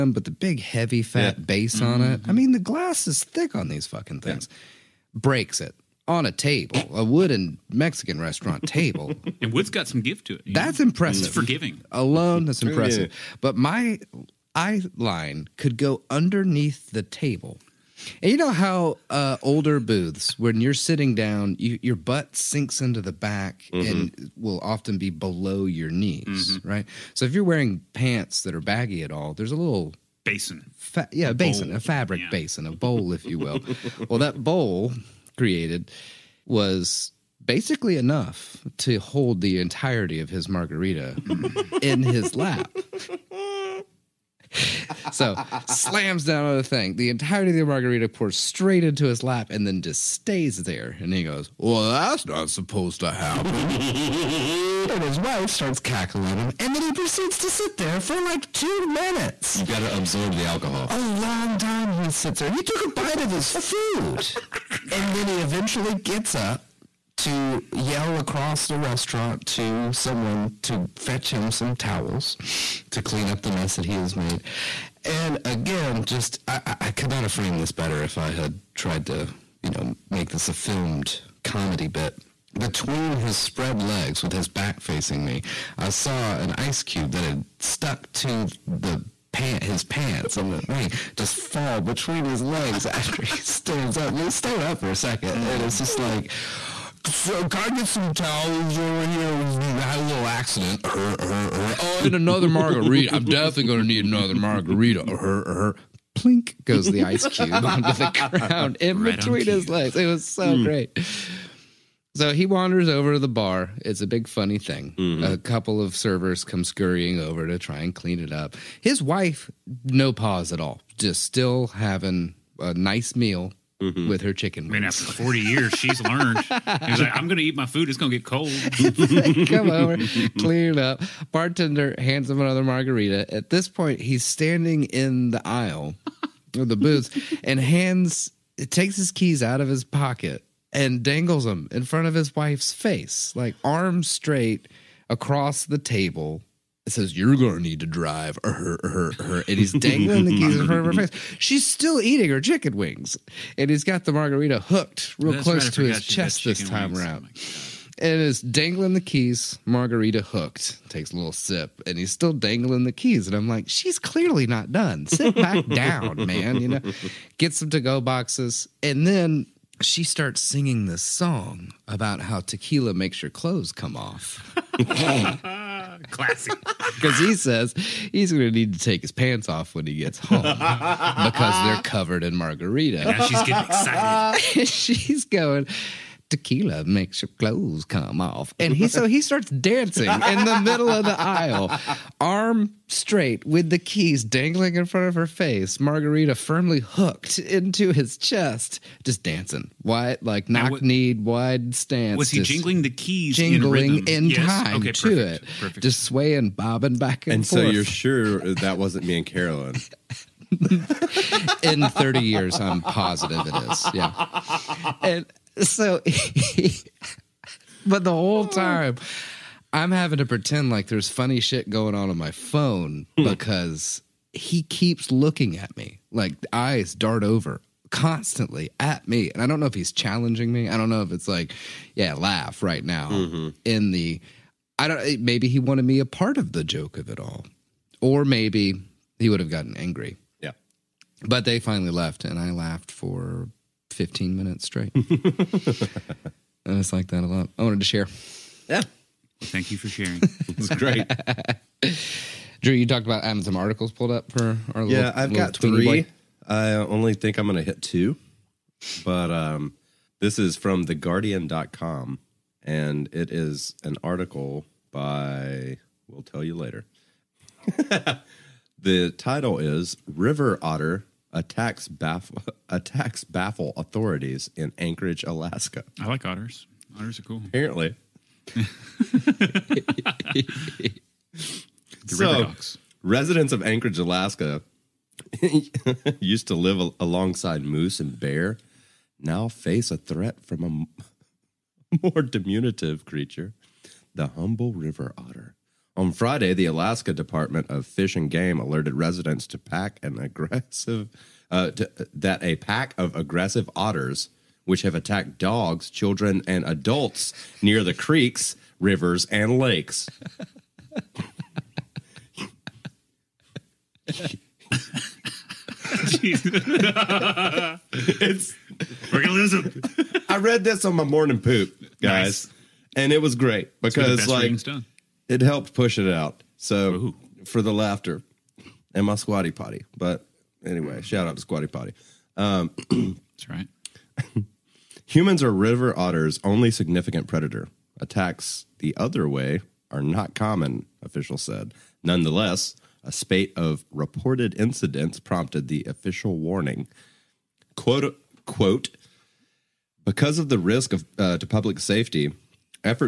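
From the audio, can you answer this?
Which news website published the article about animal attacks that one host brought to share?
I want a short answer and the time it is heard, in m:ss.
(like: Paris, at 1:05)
theguardian.com, at 4:20.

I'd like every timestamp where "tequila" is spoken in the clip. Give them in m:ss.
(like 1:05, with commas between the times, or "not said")
2:52, 3:06.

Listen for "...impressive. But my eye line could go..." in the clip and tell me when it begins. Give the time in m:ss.
0:12.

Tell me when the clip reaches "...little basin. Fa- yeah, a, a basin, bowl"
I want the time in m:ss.
0:29.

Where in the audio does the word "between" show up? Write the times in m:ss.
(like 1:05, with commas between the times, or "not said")
1:22, 1:31, 1:49.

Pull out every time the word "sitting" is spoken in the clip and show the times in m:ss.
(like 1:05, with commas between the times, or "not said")
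0:20.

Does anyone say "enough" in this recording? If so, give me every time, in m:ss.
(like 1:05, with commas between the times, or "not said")
0:37.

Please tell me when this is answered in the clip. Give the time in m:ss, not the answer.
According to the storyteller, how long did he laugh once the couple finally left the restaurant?
4:03.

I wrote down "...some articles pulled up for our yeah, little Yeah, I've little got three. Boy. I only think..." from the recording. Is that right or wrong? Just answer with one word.
right.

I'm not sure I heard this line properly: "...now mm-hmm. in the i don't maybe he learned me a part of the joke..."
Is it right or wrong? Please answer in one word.
wrong.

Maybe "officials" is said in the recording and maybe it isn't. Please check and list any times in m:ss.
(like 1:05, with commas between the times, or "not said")
5:41, 5:45.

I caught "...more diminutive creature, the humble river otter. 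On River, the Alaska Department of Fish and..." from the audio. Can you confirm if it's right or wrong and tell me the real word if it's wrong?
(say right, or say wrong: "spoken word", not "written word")
wrong: "Friday", not "River".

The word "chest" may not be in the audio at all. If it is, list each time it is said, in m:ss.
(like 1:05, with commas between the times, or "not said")
2:36, 3:18.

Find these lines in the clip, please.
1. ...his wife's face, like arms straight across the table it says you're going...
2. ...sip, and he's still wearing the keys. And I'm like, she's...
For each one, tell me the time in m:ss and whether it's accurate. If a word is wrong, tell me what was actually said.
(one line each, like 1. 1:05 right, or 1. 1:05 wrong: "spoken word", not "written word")
1. 2:22 right
2. 2:41 wrong: "dangling", not "wearing".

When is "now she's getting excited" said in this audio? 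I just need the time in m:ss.
3:03.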